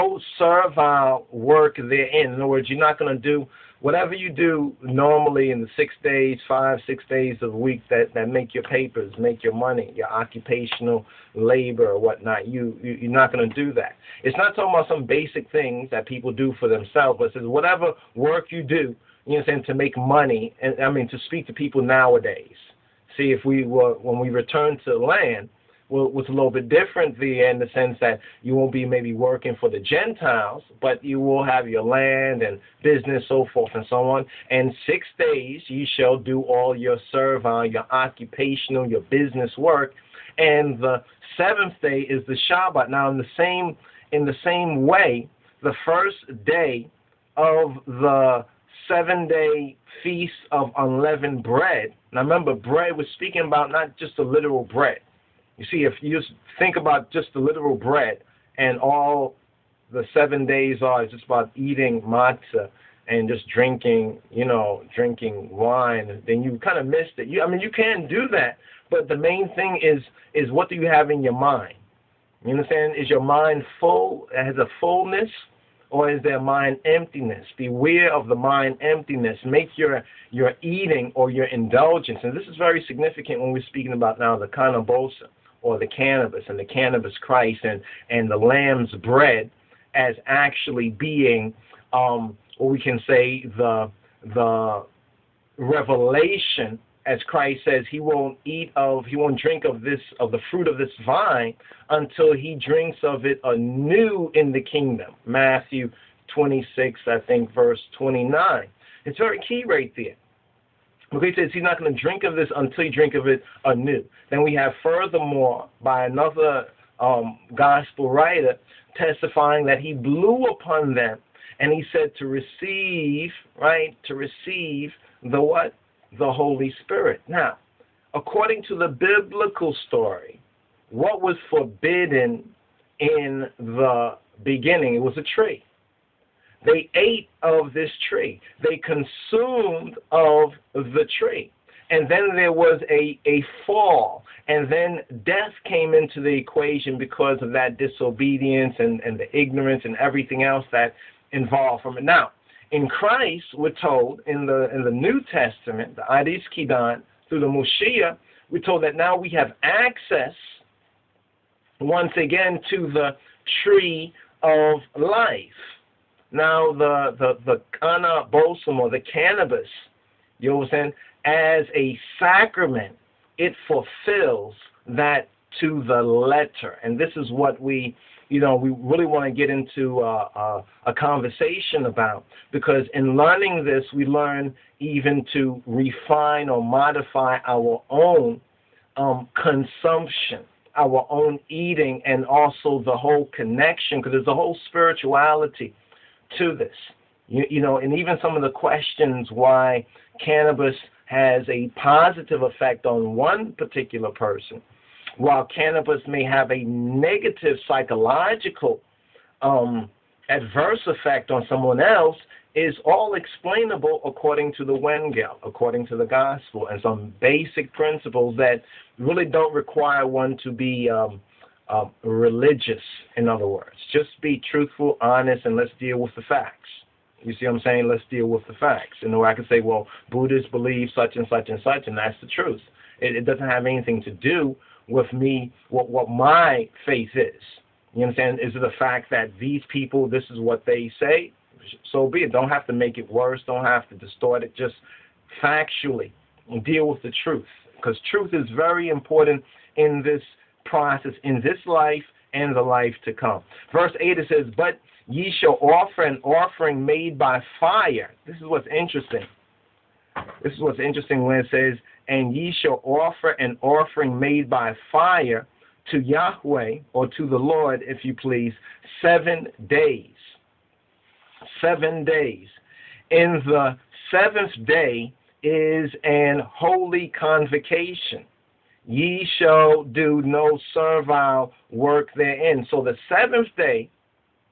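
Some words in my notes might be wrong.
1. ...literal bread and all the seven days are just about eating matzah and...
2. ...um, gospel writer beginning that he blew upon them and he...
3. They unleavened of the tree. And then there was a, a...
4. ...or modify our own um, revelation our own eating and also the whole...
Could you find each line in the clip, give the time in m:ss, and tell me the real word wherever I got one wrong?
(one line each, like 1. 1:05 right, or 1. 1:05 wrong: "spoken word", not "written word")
1. 0:57 right
2. 1:56 wrong: "testifying", not "beginning"
3. 2:18 wrong: "consumed", not "unleavened"
4. 3:06 wrong: "consumption", not "revelation".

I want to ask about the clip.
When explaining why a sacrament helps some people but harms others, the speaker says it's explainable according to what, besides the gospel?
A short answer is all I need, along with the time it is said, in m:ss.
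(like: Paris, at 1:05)
the Wengel, at 3:34.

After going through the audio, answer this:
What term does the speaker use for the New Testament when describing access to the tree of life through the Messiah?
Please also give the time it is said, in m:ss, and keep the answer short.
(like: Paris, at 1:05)
Adis Kidan, at 2:36.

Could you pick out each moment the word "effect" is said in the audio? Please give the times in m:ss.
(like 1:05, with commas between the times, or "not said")
3:22, 3:30.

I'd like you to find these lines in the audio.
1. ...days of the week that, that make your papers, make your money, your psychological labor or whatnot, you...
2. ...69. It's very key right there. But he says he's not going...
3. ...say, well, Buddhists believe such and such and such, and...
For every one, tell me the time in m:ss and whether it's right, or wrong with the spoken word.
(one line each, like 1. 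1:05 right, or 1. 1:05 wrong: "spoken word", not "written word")
1. 0:07 wrong: "occupational", not "psychological"
2. 1:47 wrong: "29", not "69"
3. 3:49 right.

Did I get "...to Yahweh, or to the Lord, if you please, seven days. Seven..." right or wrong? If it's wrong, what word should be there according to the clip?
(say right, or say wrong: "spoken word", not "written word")
right.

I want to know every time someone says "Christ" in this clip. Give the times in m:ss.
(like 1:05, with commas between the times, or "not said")
1:27, 1:37, 2:32.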